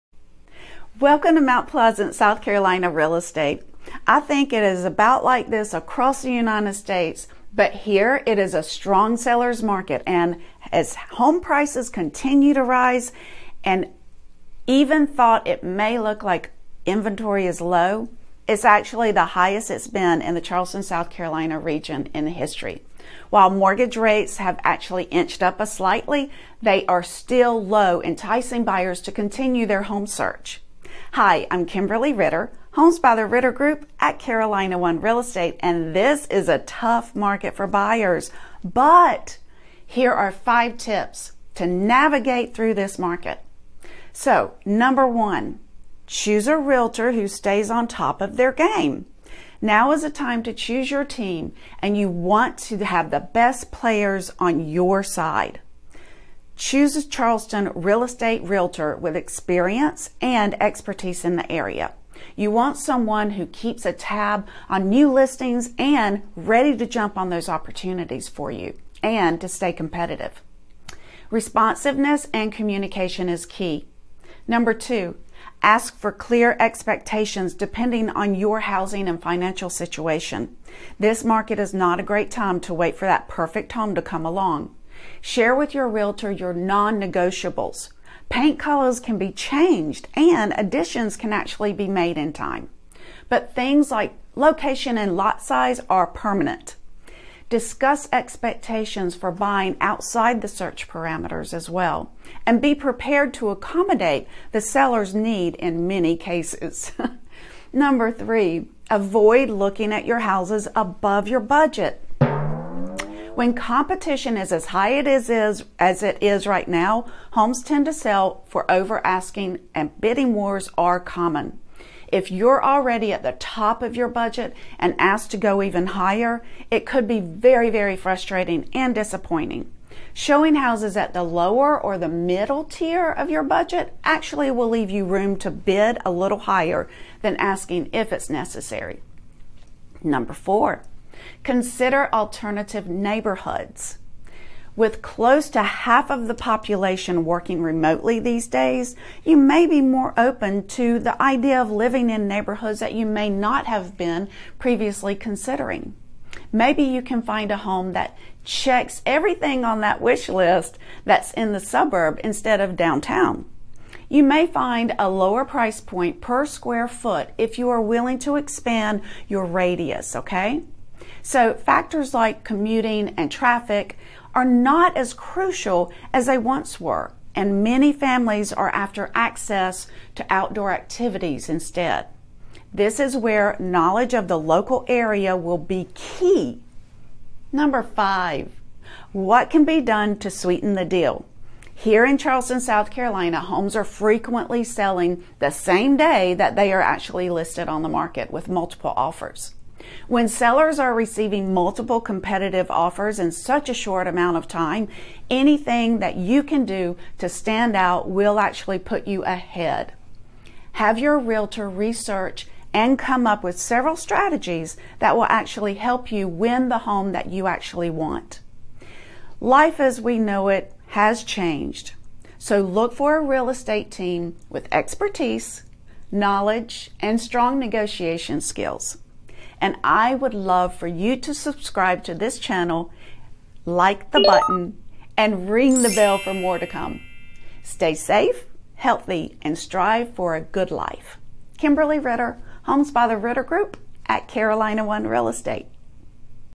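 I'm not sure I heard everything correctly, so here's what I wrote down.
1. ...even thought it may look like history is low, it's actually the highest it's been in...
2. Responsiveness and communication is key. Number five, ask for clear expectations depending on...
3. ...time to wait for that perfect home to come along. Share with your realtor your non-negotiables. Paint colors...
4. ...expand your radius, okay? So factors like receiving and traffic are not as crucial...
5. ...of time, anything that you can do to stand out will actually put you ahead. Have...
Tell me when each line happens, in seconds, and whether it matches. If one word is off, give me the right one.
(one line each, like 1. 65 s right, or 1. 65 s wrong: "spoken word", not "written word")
1. 14 s wrong: "inventory", not "history"
2. 71 s wrong: "two", not "five"
3. 82 s right
4. 168 s wrong: "commuting", not "receiving"
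5. 204 s right.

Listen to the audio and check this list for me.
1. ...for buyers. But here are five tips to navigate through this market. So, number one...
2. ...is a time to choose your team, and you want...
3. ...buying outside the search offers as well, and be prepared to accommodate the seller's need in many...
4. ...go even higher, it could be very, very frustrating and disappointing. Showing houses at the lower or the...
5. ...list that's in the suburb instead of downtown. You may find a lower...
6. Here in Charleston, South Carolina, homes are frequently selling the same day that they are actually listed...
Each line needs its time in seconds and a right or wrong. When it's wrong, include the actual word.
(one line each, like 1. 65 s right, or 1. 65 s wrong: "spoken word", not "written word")
1. 37 s right
2. 49 s right
3. 99 s wrong: "parameters", not "offers"
4. 125 s right
5. 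160 s right
6. 191 s right.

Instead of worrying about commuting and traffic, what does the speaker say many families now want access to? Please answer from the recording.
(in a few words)
Outdoor activities.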